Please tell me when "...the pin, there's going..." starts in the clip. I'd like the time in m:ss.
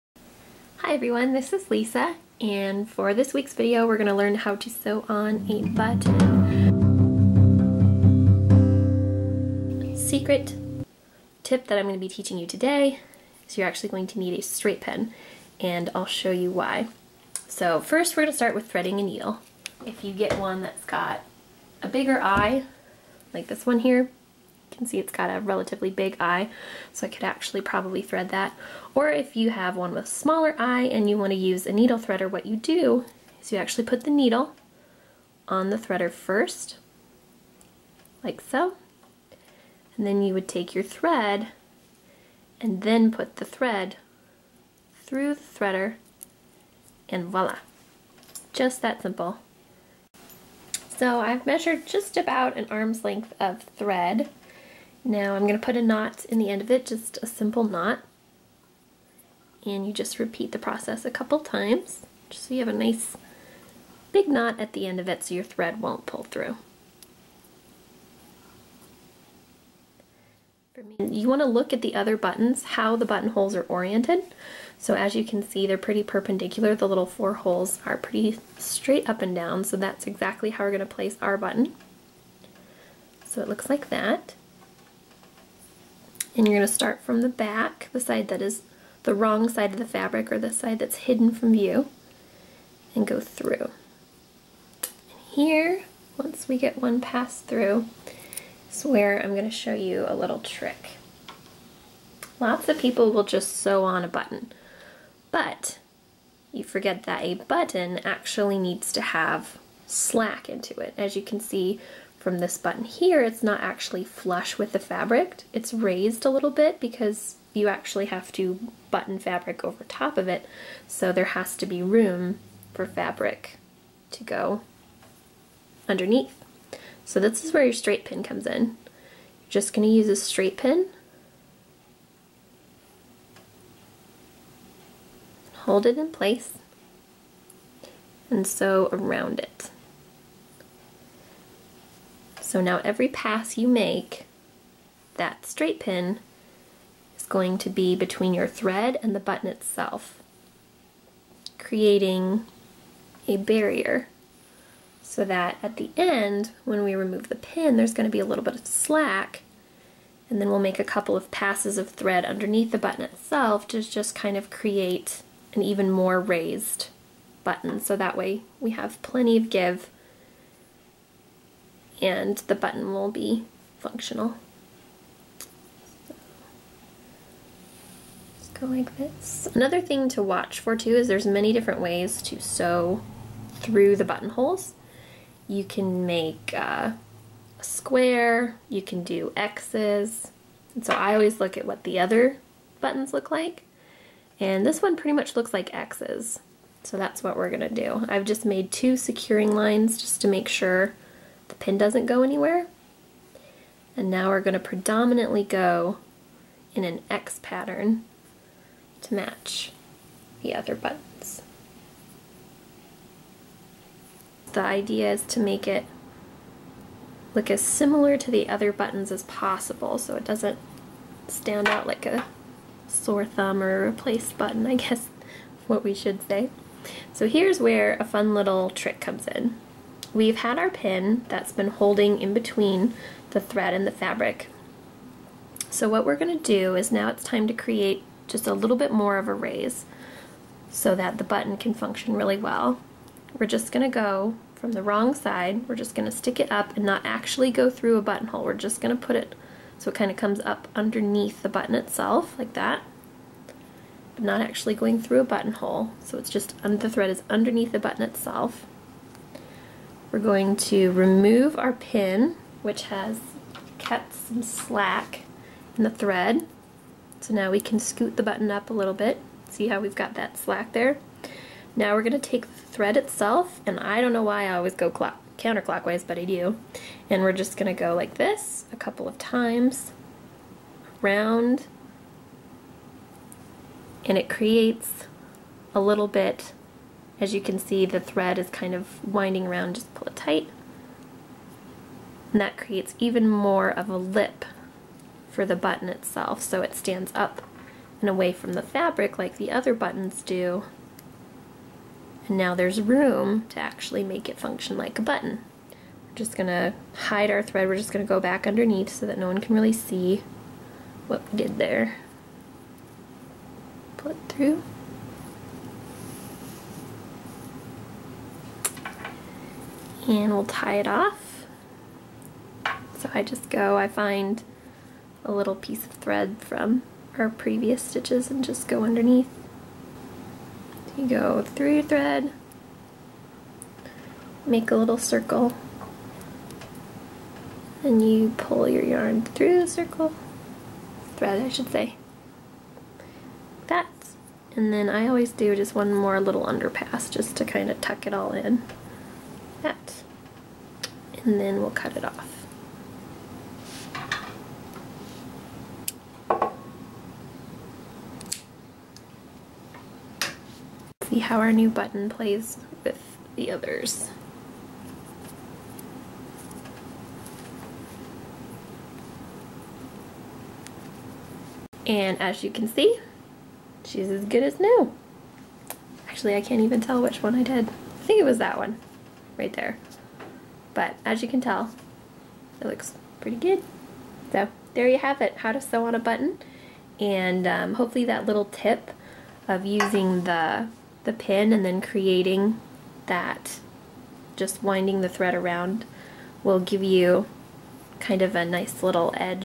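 2:37.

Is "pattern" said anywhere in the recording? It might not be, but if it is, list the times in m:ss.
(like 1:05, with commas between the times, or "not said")
3:27.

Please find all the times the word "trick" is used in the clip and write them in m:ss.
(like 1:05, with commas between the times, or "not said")
1:40, 3:48.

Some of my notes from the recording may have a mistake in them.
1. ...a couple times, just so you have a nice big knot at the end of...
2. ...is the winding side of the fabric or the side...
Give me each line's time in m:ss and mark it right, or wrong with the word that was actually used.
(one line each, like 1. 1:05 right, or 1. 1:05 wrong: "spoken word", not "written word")
1. 1:01 right
2. 1:28 wrong: "wrong", not "winding".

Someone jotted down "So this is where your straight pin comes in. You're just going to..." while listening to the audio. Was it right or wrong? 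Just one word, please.
right.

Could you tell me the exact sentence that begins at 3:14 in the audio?
And this one pretty much looks like X's.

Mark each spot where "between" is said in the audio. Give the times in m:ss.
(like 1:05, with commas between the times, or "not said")
2:27, 3:52.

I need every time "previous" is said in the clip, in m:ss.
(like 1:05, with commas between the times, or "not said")
5:27.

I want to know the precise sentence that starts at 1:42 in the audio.
Lots of people will just sew on a button, but you forget that a button actually needs to have slack into it.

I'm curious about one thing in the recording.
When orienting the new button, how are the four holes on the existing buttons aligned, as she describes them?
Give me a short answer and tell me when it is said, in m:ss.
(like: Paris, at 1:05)
perpendicular, at 1:16.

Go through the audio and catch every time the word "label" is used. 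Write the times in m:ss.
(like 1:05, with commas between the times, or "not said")
not said.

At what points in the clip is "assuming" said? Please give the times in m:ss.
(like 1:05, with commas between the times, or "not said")
not said.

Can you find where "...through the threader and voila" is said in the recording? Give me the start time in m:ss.
0:45.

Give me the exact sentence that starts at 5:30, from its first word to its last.
you go through your thread, make a little circle, and you pull your yarn through the circle, thread I should say.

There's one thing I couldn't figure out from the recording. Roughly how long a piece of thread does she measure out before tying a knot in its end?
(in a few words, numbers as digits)
an arm's length.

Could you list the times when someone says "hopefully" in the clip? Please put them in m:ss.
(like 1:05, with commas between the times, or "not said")
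6:27.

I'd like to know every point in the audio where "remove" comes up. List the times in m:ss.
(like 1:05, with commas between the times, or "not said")
2:36, 4:20.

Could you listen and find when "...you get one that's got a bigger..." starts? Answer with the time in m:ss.
0:20.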